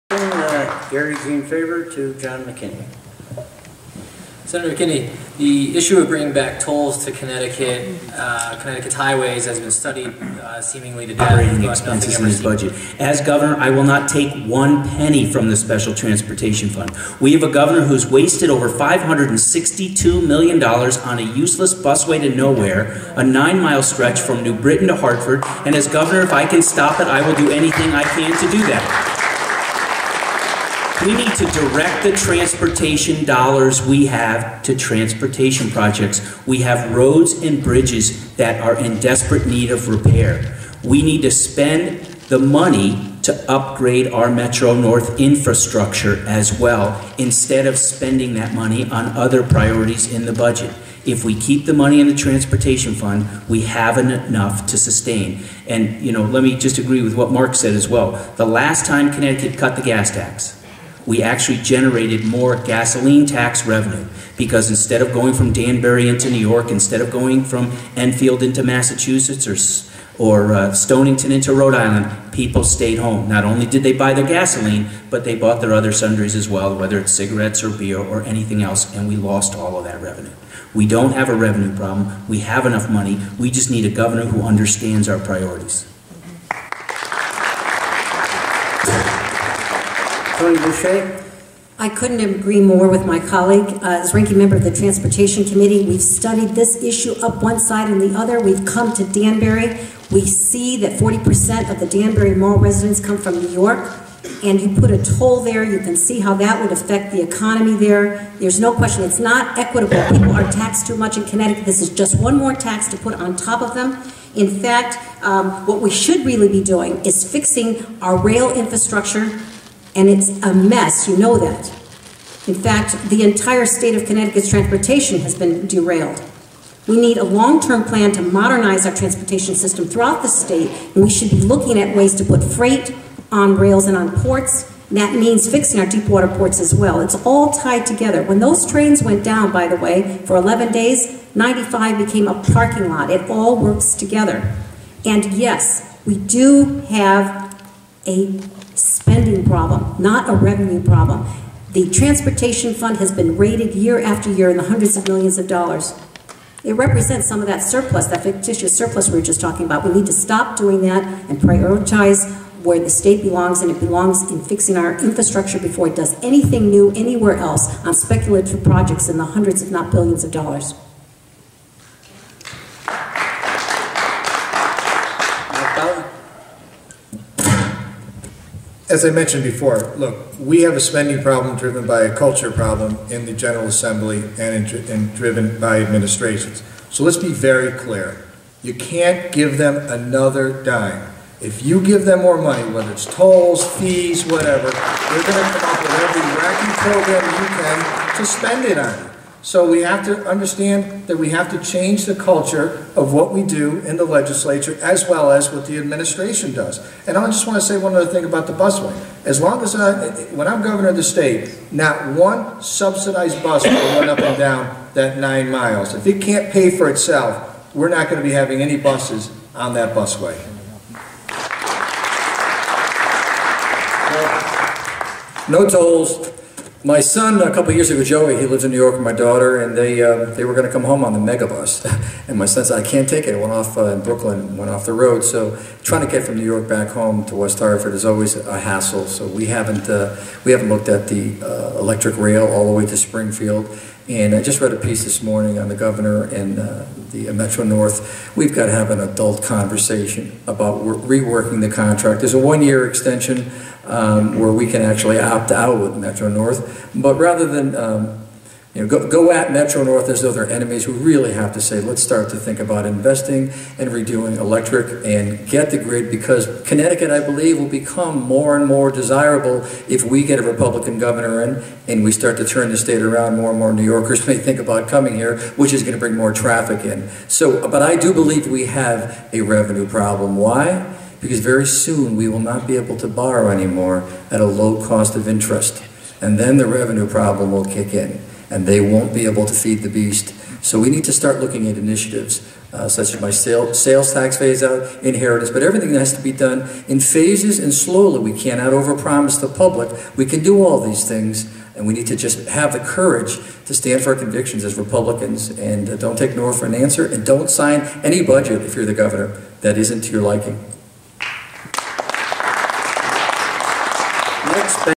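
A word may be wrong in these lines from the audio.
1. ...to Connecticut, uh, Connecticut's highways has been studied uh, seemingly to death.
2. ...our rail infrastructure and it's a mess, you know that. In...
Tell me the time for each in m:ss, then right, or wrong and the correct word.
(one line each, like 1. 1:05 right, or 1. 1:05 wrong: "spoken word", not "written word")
1. 0:07 right
2. 1:58 right.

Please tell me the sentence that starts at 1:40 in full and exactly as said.
We see that 40% of the Danbury Mall residents come from New York.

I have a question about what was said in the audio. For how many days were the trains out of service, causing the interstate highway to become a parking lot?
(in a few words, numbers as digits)
11 days.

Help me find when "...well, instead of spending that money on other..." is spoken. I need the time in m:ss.
0:46.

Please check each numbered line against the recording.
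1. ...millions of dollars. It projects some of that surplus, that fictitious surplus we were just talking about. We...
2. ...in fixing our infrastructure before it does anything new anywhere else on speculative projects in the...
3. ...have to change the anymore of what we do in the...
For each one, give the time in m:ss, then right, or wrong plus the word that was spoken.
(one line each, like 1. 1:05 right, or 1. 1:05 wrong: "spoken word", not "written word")
1. 2:35 wrong: "represents", not "projects"
2. 2:44 right
3. 3:21 wrong: "culture", not "anymore".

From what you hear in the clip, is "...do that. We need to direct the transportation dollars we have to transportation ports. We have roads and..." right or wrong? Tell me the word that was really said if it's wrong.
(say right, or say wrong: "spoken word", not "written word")
wrong: "projects", not "ports".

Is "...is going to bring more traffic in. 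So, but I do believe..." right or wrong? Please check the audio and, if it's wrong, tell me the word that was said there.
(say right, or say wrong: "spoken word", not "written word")
right.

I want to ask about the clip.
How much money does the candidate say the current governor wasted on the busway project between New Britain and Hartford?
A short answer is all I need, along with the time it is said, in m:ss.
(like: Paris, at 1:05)
$562 million, at 0:18.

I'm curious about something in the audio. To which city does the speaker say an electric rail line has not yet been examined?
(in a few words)
Springfield.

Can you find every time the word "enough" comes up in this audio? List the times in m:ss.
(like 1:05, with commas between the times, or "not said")
0:53, 1:22.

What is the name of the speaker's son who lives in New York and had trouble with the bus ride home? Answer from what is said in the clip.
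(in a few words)
Joey.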